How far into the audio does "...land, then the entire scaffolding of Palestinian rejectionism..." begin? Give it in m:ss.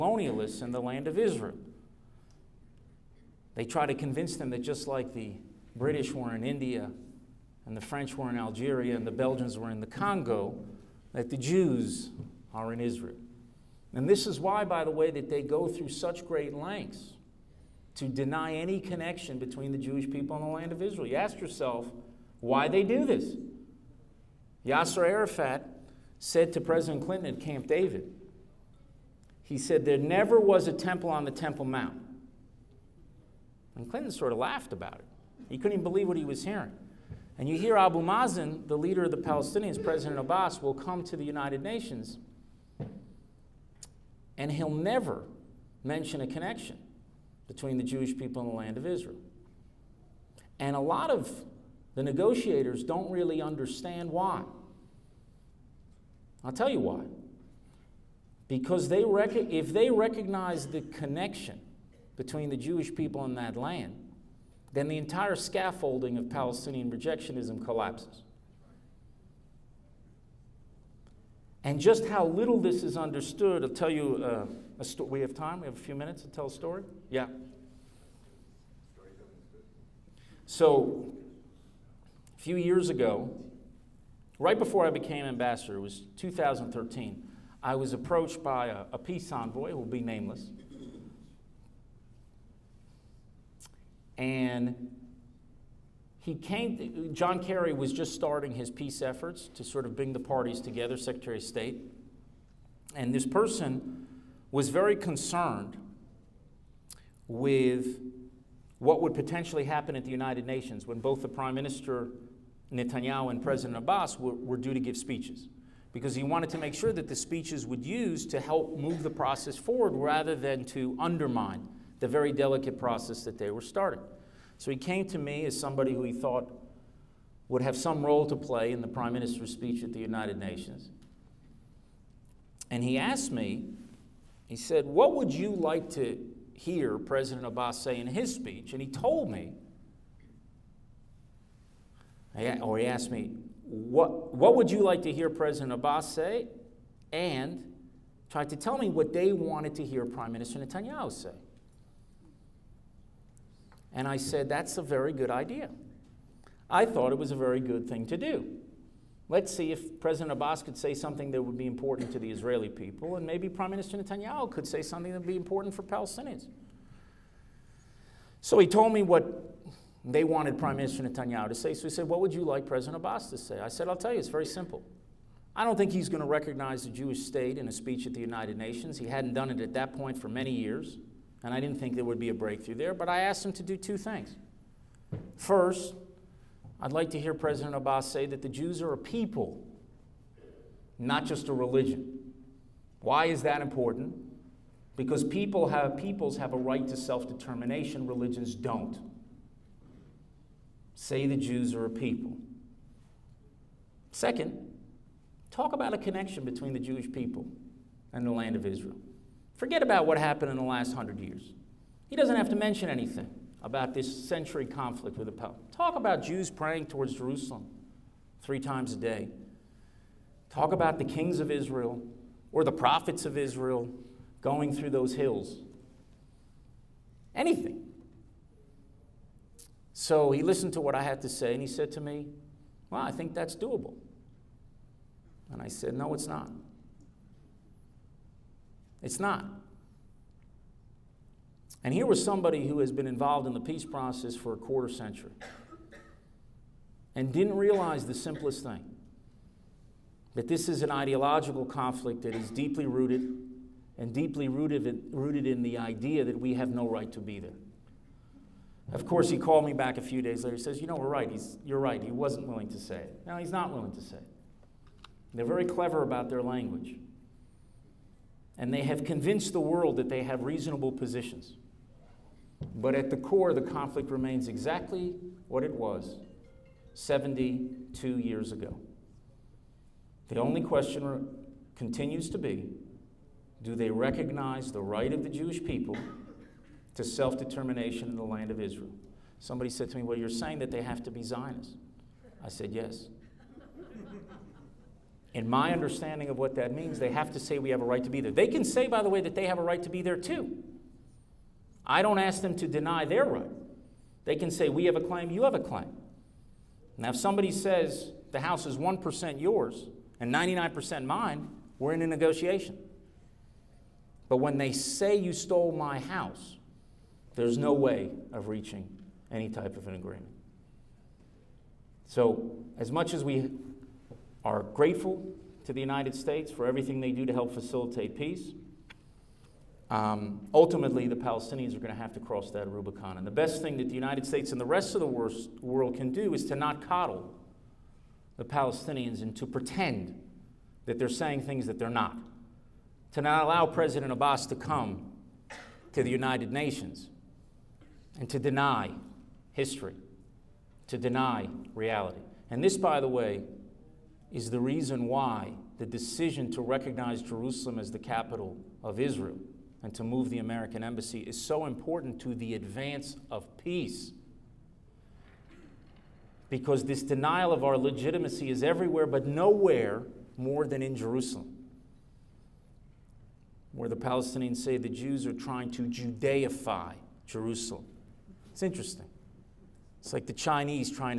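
1:03.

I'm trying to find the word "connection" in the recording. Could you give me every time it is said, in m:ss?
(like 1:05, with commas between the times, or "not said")
0:18, 0:46, 1:00, 3:25.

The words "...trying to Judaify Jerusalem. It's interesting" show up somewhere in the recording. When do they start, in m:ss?
6:15.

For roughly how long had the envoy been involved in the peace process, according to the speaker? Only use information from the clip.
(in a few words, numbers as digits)
a quarter century.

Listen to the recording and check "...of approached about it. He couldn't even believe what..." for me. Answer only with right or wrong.
wrong.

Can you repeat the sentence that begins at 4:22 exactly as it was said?
He wasn't willing to say it.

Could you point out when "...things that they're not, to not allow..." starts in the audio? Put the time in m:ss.
5:41.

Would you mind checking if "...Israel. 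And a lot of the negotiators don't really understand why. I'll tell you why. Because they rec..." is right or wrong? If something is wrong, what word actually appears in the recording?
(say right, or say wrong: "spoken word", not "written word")
right.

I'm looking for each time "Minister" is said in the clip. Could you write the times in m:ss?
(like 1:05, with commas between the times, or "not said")
1:51, 2:09, 2:30, 2:43, 2:50.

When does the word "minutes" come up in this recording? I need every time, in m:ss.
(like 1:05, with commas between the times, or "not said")
1:15.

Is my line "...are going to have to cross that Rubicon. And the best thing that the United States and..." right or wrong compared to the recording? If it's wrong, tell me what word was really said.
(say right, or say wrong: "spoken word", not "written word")
right.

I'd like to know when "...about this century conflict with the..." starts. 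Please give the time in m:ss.
3:33.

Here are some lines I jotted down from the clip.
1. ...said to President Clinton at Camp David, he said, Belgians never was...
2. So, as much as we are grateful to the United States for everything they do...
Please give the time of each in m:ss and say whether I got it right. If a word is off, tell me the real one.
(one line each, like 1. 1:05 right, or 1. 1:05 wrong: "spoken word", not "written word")
1. 0:26 wrong: "There", not "Belgians"
2. 5:22 right.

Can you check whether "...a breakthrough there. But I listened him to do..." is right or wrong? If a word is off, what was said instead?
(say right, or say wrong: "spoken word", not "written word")
wrong: "asked", not "listened".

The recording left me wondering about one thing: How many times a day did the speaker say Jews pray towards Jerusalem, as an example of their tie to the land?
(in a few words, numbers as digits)
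3.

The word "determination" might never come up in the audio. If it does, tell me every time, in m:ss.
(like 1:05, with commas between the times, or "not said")
3:17, 4:47.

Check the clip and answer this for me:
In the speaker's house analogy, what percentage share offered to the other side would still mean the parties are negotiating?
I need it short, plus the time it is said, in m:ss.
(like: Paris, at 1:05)
1%, at 5:08.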